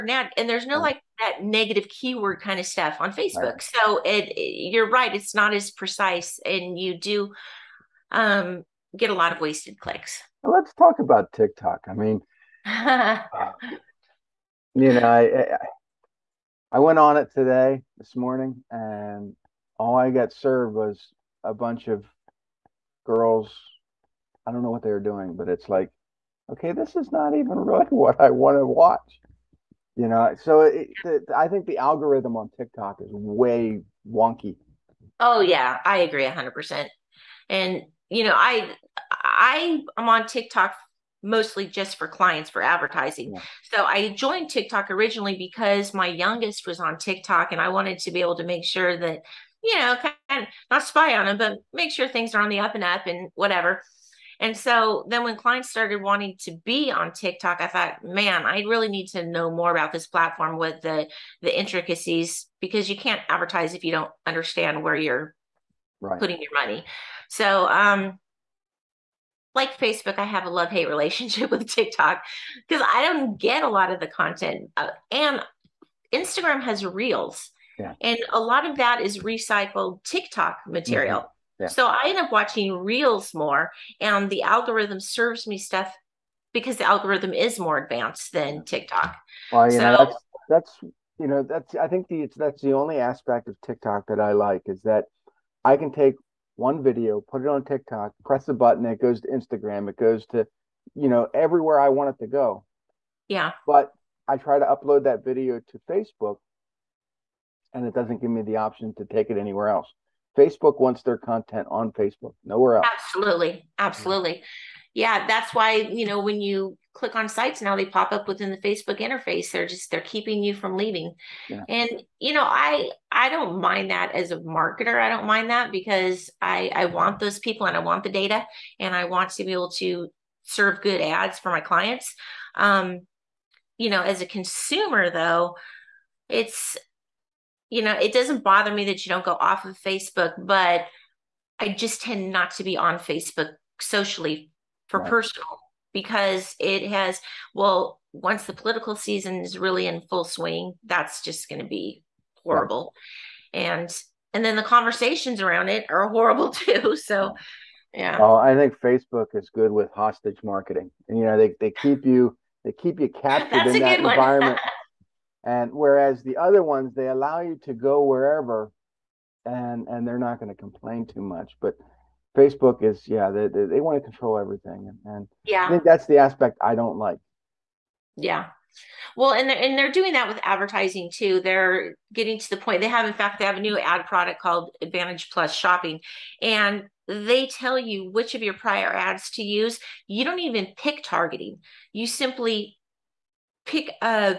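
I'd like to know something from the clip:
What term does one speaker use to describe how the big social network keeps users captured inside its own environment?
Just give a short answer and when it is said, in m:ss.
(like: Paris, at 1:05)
hostage marketing, at 2:39.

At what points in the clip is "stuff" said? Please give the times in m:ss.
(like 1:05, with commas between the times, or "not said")
0:02, 1:25.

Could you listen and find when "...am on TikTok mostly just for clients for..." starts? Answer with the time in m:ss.
0:39.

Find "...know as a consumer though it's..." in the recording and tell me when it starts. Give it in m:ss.
2:13.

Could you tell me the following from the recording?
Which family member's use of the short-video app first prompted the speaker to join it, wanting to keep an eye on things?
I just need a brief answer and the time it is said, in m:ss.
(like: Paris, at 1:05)
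youngest, at 0:45.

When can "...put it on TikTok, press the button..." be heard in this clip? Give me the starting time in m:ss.
1:37.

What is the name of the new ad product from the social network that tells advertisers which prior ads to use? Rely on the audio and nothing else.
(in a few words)
Advantage Plus Shopping.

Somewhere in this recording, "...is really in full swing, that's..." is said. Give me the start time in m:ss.
2:29.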